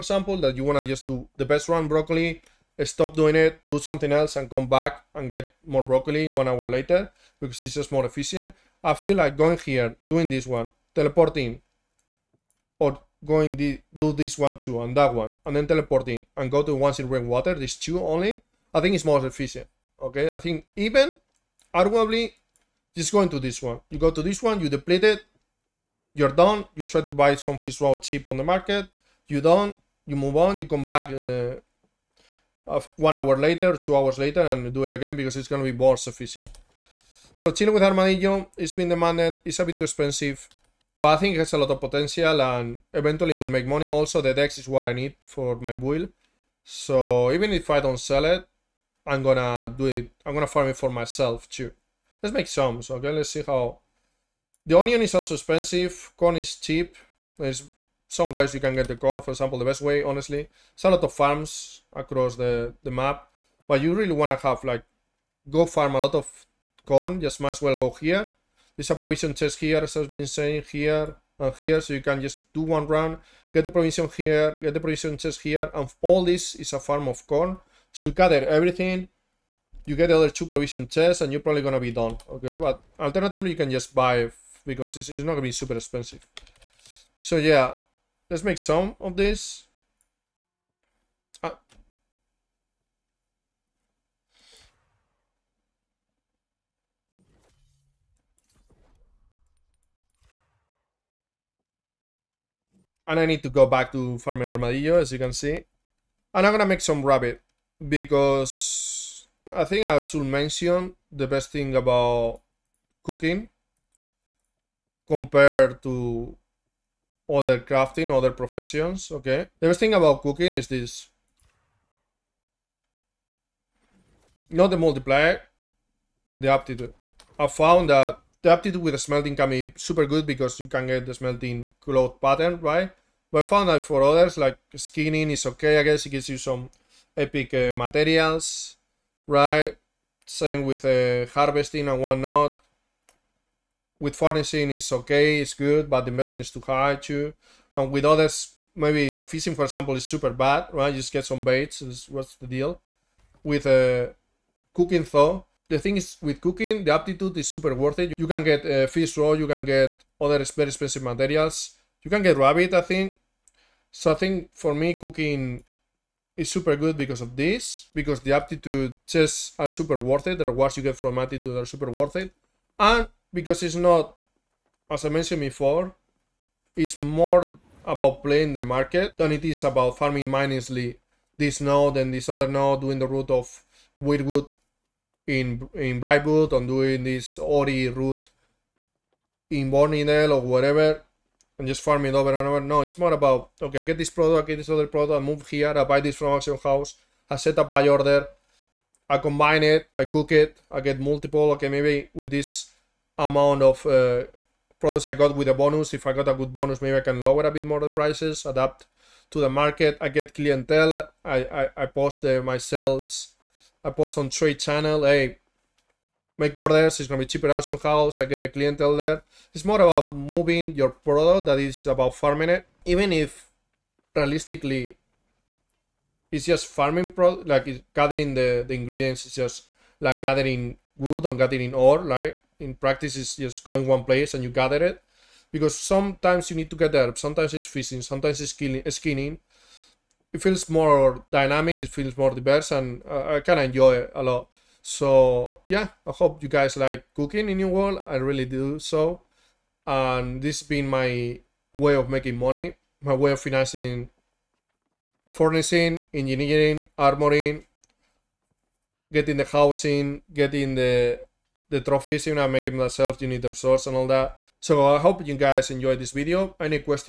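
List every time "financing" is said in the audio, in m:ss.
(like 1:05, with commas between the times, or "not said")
4:13.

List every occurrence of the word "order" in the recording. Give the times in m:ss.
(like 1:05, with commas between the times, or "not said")
3:17, 3:36.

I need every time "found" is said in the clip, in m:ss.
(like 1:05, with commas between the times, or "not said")
2:07, 2:13.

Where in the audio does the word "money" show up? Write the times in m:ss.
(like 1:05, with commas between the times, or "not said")
0:43, 4:12.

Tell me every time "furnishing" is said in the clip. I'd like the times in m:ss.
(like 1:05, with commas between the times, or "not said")
2:24, 4:15.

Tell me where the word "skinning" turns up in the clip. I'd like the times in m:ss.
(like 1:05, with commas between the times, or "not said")
2:14, 3:58.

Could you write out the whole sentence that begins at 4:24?
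So I hope you guys enjoyed this video.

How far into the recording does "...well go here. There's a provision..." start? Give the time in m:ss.
1:07.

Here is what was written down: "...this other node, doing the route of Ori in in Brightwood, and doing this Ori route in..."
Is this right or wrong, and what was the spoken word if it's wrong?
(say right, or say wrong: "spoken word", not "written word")
wrong: "Wyrdwood", not "Ori".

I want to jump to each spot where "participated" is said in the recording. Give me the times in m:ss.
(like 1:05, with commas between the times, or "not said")
not said.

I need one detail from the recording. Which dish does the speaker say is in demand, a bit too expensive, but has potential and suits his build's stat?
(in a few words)
Chile with Armadillo.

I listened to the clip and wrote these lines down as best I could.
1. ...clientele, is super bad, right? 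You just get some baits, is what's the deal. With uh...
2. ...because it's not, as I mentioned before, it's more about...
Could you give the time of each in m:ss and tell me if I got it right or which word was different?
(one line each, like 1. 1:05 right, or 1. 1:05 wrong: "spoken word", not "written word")
1. 2:29 wrong: "example", not "clientele"
2. 2:53 right.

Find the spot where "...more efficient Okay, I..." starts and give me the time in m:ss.
0:19.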